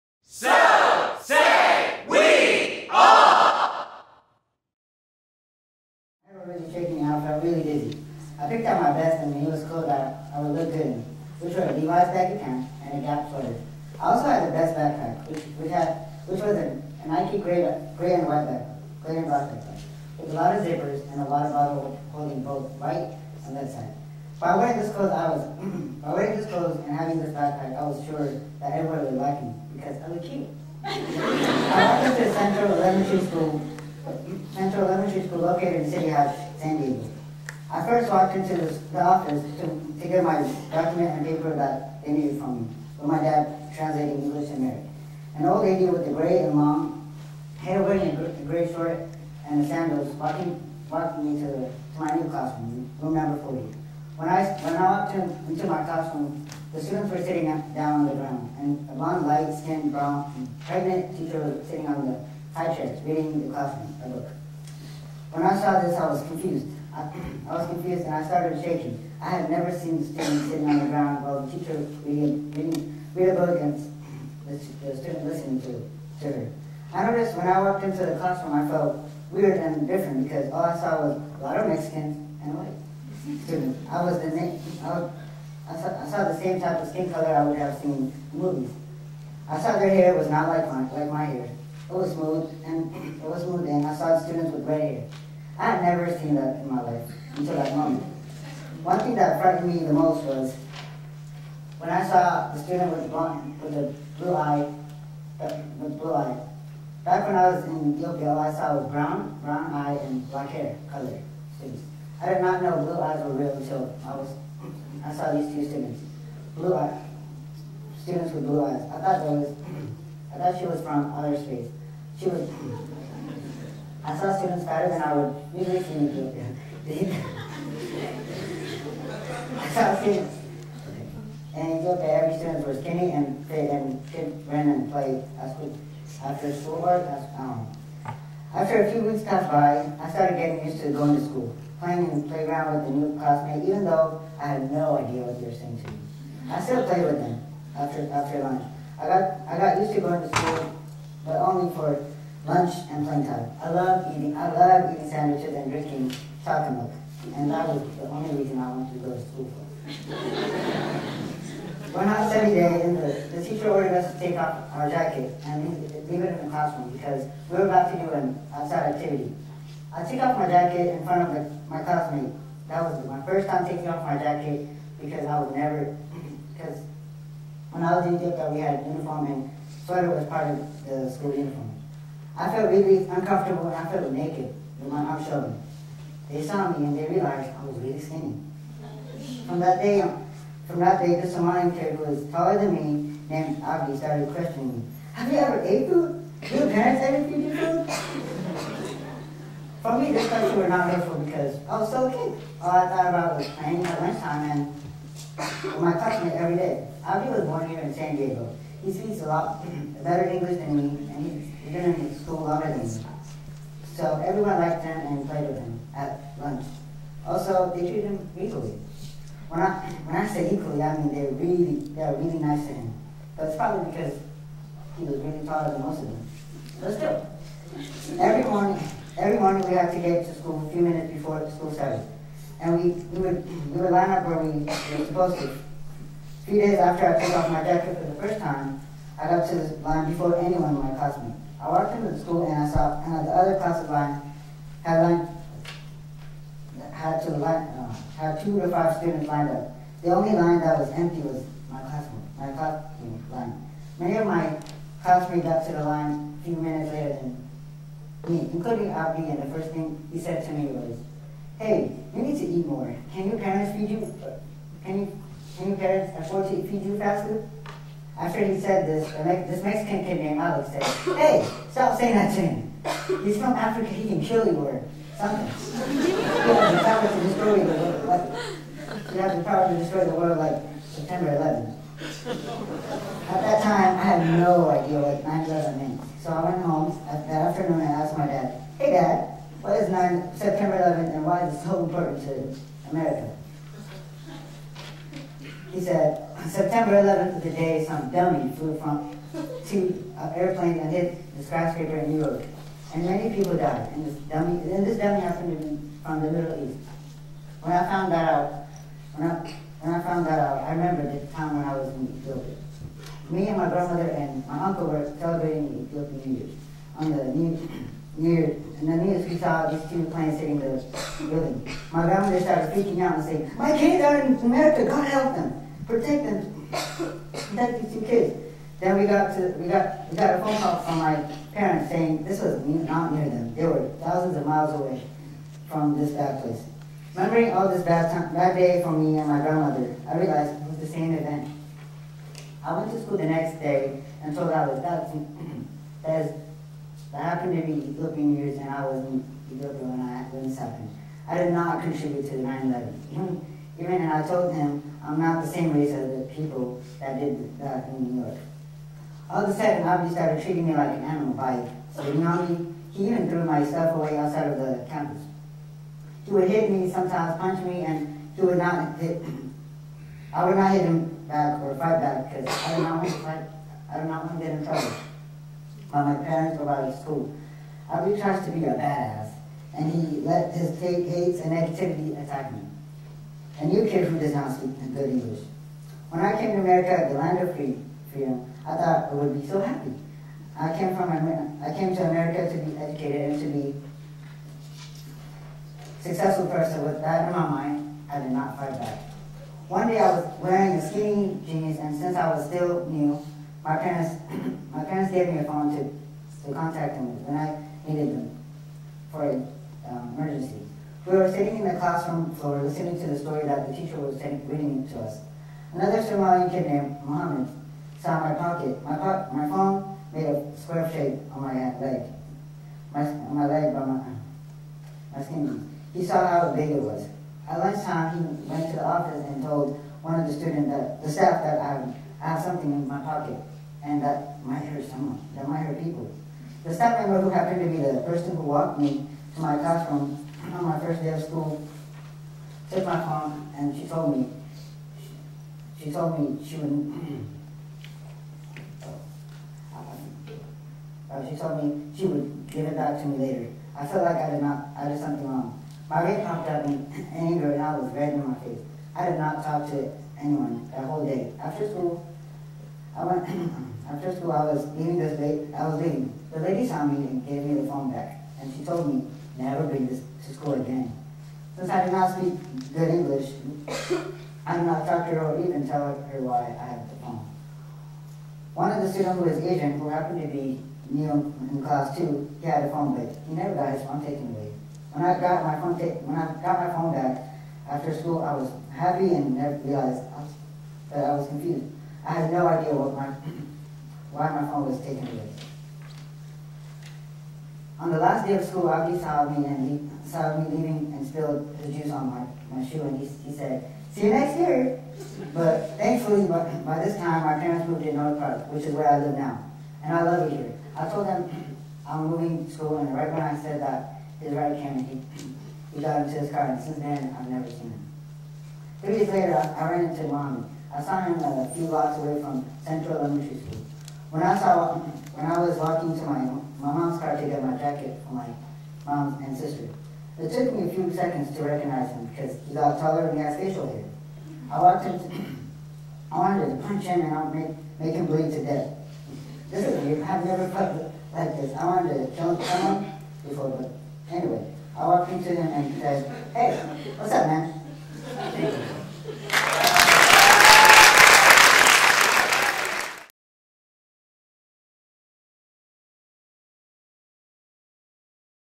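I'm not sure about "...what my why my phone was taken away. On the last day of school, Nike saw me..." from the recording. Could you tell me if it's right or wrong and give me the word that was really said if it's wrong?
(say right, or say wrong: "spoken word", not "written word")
wrong: "Abdi", not "Nike".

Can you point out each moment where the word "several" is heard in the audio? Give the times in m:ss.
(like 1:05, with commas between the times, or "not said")
not said.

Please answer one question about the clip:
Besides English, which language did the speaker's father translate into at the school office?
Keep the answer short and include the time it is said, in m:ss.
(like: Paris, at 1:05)
Amharic, at 0:44.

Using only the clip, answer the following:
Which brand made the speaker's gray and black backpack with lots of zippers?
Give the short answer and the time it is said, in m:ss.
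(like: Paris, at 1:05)
Nike, at 0:17.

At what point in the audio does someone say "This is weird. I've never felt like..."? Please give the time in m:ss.
8:59.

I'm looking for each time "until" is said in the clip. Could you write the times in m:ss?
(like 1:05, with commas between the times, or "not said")
1:37, 1:53.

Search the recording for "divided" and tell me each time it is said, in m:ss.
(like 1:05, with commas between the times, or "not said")
not said.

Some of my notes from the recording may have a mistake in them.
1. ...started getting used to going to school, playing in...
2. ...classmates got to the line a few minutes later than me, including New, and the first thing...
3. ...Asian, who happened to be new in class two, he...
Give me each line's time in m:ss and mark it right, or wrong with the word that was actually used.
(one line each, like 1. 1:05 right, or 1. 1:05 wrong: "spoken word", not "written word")
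1. 2:20 right
2. 4:15 wrong: "Abdi", not "New"
3. 7:59 right.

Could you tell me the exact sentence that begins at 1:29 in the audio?
I saw their hair was not like my like my hair.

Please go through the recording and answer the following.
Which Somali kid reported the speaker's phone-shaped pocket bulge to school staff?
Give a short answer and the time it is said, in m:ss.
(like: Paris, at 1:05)
Mohammed, at 6:57.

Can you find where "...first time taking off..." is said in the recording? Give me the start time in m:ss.
2:53.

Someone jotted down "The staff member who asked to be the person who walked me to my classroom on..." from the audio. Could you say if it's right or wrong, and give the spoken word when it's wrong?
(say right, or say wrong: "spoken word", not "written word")
wrong: "happened", not "asked".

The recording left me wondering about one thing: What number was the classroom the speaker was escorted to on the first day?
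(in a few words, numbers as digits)
40.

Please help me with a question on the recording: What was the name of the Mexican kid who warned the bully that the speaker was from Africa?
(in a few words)
Alex.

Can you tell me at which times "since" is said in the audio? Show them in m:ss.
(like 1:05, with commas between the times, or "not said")
6:41, 7:51, 8:36.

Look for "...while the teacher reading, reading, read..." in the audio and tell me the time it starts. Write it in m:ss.
1:11.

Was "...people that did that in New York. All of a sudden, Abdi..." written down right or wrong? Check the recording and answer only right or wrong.
right.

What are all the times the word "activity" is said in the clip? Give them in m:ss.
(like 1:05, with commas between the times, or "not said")
2:48.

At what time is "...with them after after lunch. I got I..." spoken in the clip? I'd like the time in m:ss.
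2:27.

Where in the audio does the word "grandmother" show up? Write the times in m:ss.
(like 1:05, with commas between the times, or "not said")
5:13, 5:22, 5:39.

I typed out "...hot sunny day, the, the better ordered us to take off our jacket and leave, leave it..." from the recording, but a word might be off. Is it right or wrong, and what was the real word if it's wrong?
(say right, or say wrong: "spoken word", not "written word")
wrong: "teacher", not "better".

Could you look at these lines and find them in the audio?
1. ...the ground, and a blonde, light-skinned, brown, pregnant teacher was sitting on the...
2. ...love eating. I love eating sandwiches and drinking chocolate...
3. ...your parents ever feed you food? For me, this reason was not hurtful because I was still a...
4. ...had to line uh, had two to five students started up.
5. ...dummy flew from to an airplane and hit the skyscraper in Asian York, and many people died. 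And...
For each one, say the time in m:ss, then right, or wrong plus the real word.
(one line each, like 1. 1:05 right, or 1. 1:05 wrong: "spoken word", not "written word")
1. 0:58 right
2. 2:33 right
3. 3:16 wrong: "question", not "reason"
4. 4:06 wrong: "lined", not "started"
5. 4:58 wrong: "New", not "Asian".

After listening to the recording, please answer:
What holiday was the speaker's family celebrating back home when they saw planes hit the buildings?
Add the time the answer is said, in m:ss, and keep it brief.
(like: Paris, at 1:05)
Ethiopian New Year, at 5:15.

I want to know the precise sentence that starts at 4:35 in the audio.
you have the power to destroy the world.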